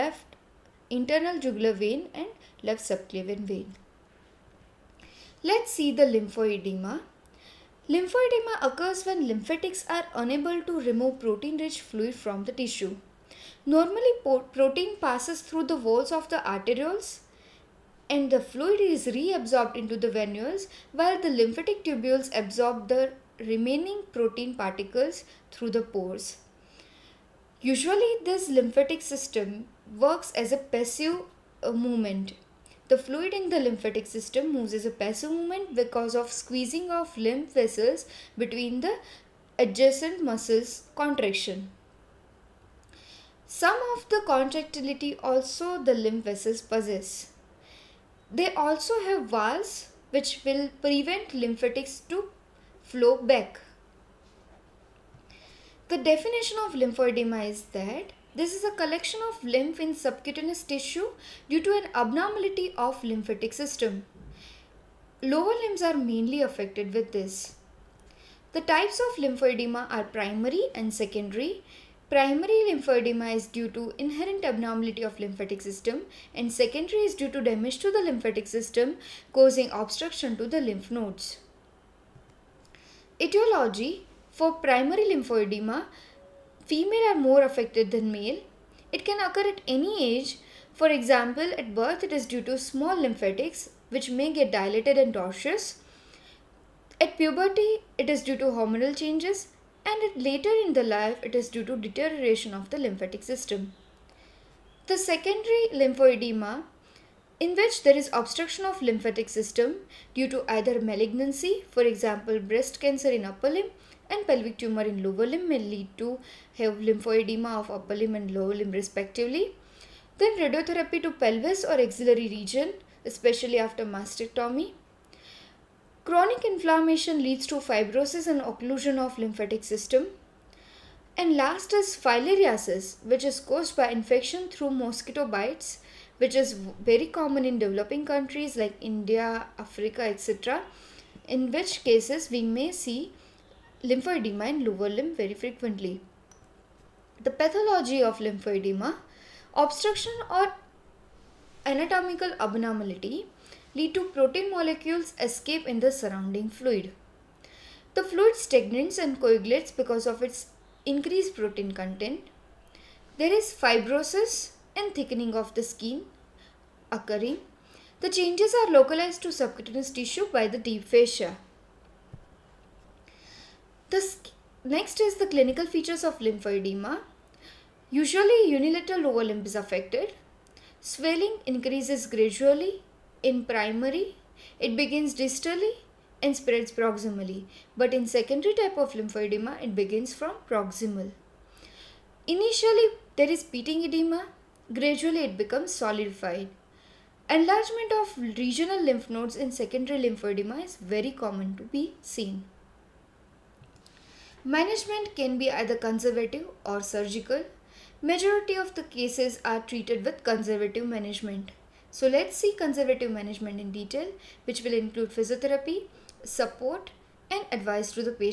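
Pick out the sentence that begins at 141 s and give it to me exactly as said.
In which cases we may see lymphedema in lower limb very frequently.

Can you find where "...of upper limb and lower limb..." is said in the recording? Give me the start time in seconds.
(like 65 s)
117 s.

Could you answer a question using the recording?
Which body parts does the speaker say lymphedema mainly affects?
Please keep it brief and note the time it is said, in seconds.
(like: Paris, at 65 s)
Lower limbs, at 65 s.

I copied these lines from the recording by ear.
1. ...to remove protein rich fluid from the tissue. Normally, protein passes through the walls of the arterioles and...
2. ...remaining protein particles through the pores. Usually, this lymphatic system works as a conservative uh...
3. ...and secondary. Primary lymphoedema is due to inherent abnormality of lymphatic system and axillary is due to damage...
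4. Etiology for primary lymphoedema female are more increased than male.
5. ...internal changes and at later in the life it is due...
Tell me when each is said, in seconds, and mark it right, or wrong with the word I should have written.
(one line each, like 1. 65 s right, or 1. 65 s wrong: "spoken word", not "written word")
1. 10 s right
2. 23 s wrong: "passive", not "conservative"
3. 70 s wrong: "secondary", not "axillary"
4. 83 s wrong: "affected", not "increased"
5. 98 s wrong: "hormonal", not "internal".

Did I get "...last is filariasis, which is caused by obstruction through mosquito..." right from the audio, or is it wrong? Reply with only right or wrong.
wrong.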